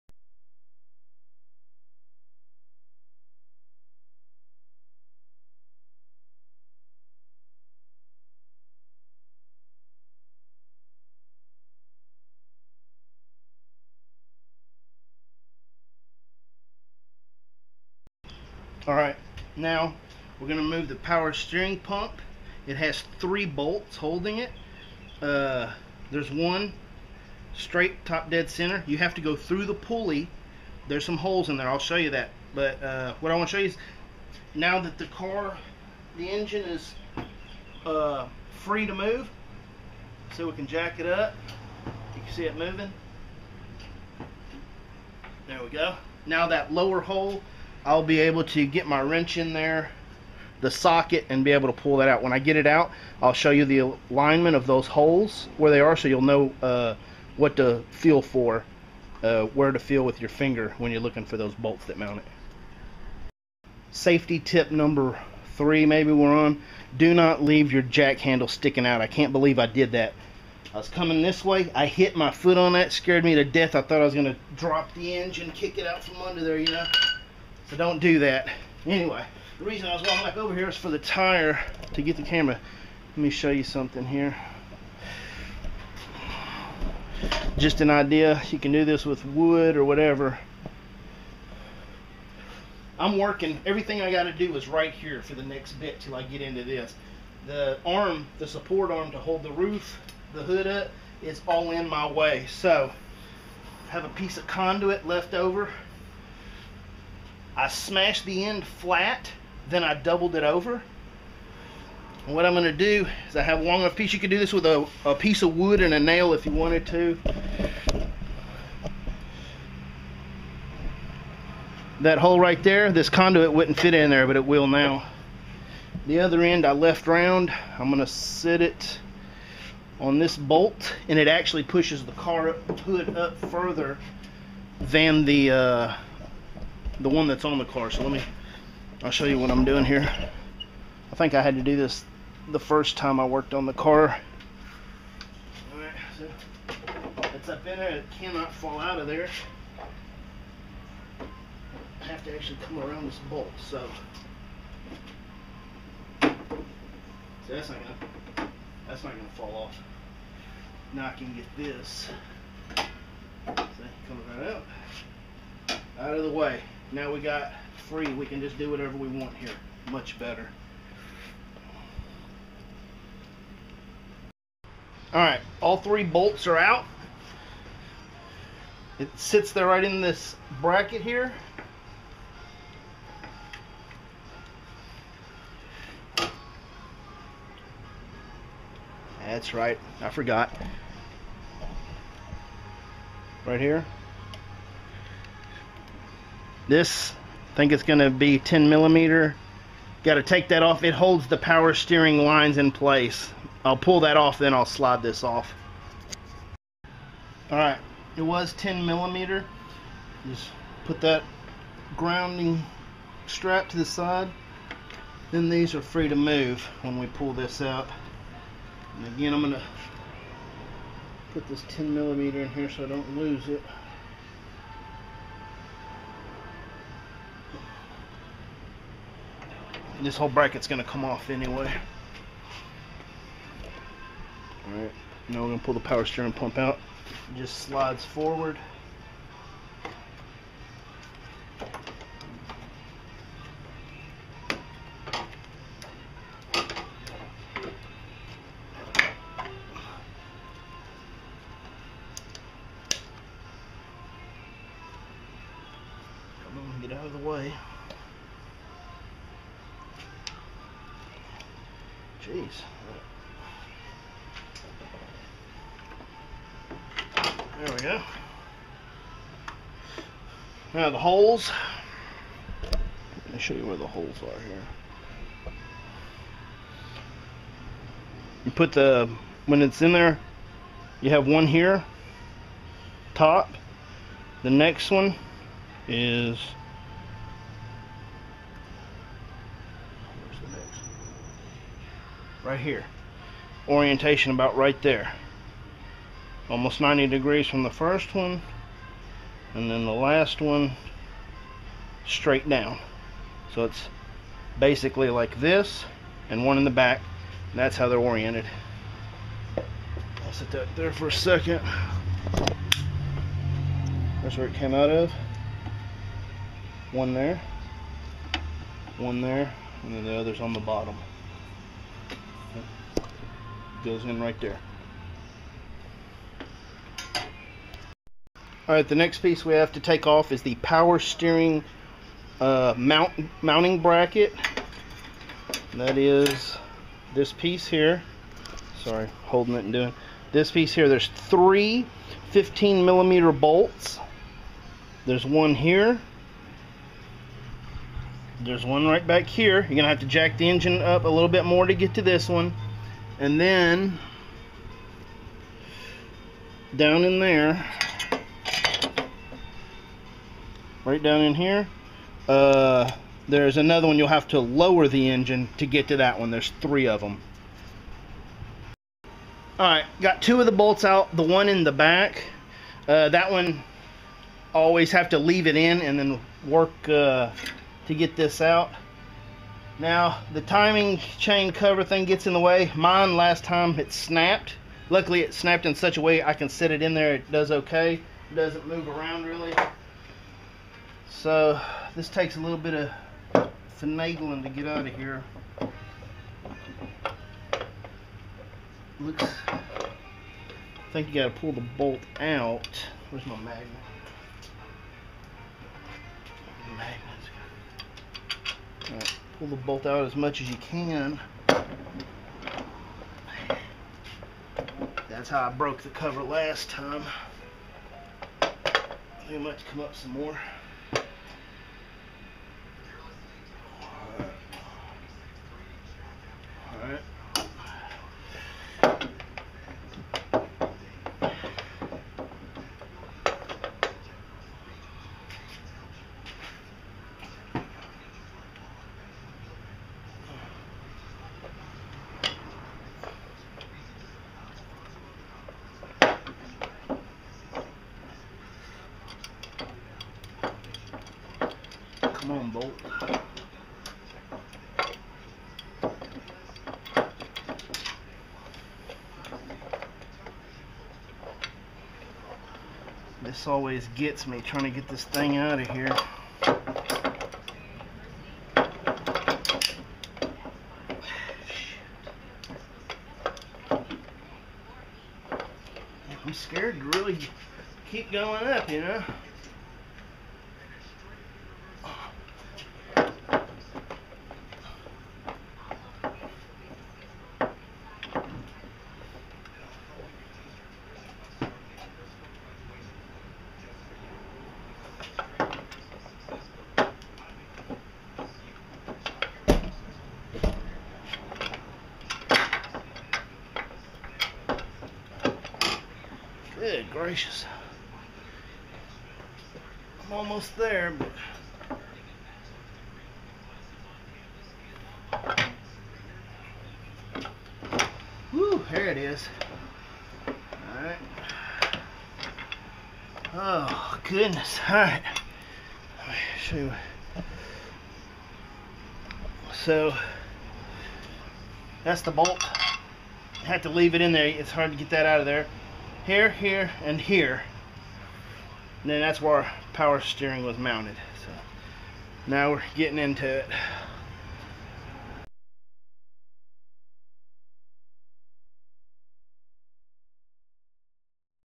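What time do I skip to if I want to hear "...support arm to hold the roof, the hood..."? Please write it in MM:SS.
01:38.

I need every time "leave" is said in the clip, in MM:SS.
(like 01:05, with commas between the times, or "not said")
01:07, 06:15, 08:53.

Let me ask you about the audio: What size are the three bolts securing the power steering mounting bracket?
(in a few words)
15 millimeter.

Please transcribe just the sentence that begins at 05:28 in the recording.
Alright, the next piece we have to take off is the power steering uh, mount, mounting bracket.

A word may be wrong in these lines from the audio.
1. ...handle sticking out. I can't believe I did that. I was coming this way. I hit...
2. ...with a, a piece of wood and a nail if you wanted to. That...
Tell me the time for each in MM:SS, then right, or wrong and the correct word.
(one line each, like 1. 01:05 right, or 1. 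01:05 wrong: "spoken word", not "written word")
1. 01:08 right
2. 01:54 right.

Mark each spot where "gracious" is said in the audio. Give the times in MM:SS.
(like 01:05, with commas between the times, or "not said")
08:26.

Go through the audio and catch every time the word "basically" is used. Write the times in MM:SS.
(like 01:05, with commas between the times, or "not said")
05:04.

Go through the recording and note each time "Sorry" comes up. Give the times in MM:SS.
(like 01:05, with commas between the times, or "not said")
05:38.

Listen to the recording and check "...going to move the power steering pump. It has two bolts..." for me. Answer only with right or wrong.
wrong.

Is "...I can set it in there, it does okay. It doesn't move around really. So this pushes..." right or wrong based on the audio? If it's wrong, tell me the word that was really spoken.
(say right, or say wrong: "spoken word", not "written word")
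wrong: "takes", not "pushes".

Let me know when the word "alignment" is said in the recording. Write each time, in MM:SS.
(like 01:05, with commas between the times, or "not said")
00:54.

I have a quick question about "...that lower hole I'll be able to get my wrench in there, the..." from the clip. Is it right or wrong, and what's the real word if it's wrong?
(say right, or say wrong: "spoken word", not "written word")
right.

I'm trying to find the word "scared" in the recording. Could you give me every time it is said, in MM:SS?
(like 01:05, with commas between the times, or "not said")
01:12, 07:56.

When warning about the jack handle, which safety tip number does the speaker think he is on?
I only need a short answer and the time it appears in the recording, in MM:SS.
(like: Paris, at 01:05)
3, at 01:04.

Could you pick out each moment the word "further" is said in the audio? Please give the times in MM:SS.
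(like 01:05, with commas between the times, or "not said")
02:13.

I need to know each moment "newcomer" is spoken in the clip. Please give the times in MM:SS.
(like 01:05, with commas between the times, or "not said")
not said.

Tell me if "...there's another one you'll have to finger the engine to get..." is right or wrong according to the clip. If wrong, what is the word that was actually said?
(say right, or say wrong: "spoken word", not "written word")
wrong: "lower", not "finger".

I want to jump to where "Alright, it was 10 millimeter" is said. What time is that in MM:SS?
03:27.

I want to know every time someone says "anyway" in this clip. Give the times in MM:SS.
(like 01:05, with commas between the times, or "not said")
01:18, 03:51.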